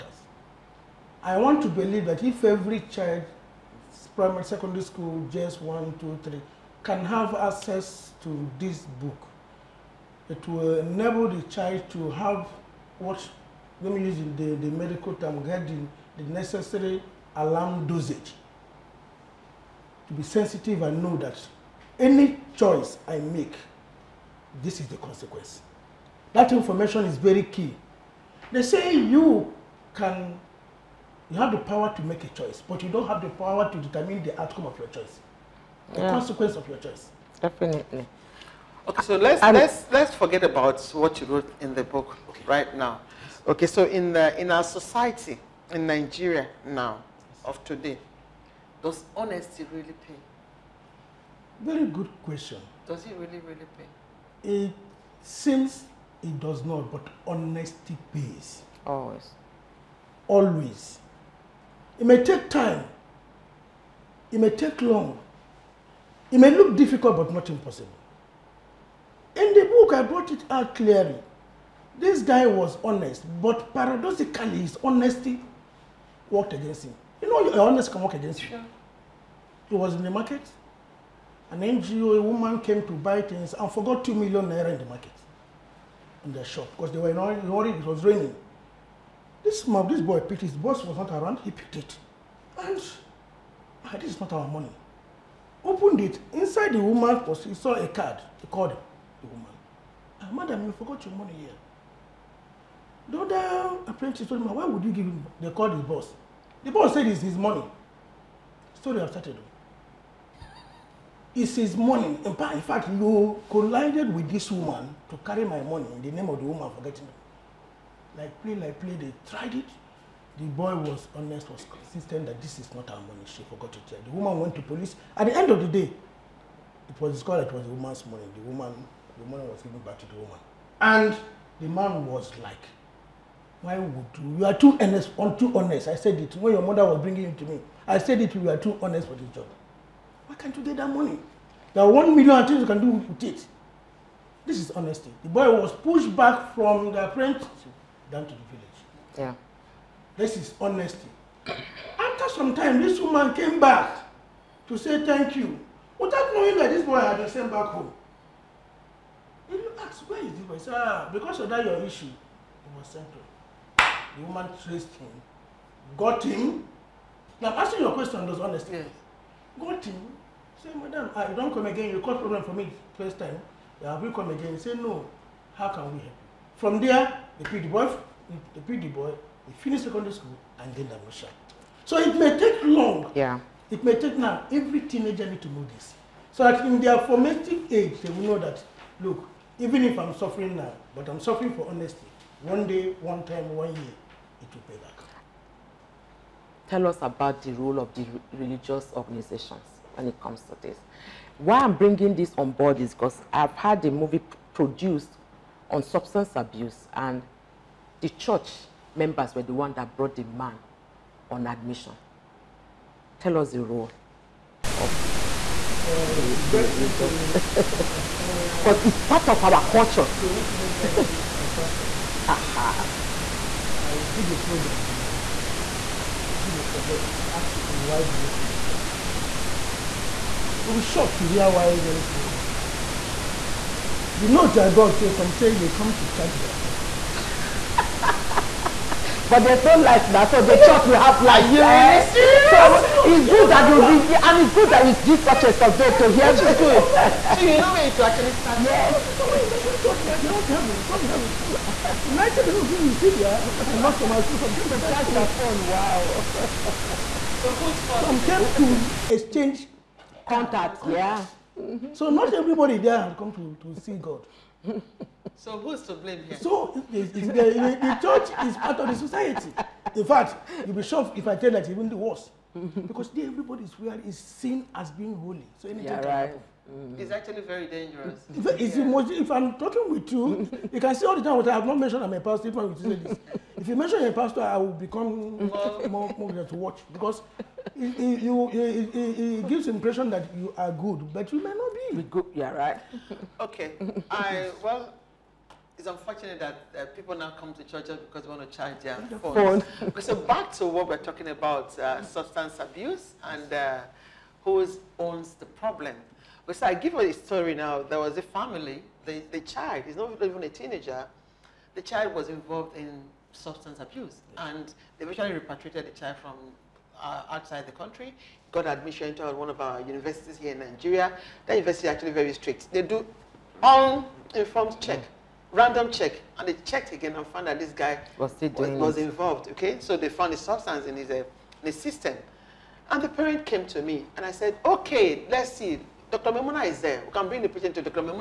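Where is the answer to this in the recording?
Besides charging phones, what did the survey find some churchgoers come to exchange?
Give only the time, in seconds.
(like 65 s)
259 s.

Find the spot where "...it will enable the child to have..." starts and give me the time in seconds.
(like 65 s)
10 s.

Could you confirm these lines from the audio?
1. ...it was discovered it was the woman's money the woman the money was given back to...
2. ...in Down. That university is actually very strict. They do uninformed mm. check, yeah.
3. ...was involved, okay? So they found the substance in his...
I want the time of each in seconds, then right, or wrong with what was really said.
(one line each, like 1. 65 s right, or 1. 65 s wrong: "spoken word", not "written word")
1. 126 s right
2. 320 s wrong: "Nigeria", not "Down"
3. 328 s right.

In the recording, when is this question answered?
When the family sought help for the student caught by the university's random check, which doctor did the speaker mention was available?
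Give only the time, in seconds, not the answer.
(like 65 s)
336 s.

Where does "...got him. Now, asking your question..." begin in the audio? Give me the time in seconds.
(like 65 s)
165 s.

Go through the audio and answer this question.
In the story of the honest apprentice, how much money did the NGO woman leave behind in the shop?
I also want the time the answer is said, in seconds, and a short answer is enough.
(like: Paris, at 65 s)
2 million naira, at 84 s.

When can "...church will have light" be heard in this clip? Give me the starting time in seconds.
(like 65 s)
240 s.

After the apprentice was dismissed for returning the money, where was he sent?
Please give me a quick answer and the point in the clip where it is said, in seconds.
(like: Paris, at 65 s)
The village, at 148 s.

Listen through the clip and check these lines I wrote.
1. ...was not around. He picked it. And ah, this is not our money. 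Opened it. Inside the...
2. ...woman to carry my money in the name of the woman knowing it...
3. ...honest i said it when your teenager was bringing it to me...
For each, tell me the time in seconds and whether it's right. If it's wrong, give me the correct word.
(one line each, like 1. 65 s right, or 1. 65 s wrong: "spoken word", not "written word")
1. 90 s right
2. 114 s wrong: "forgetting", not "knowing"
3. 135 s wrong: "mother", not "teenager".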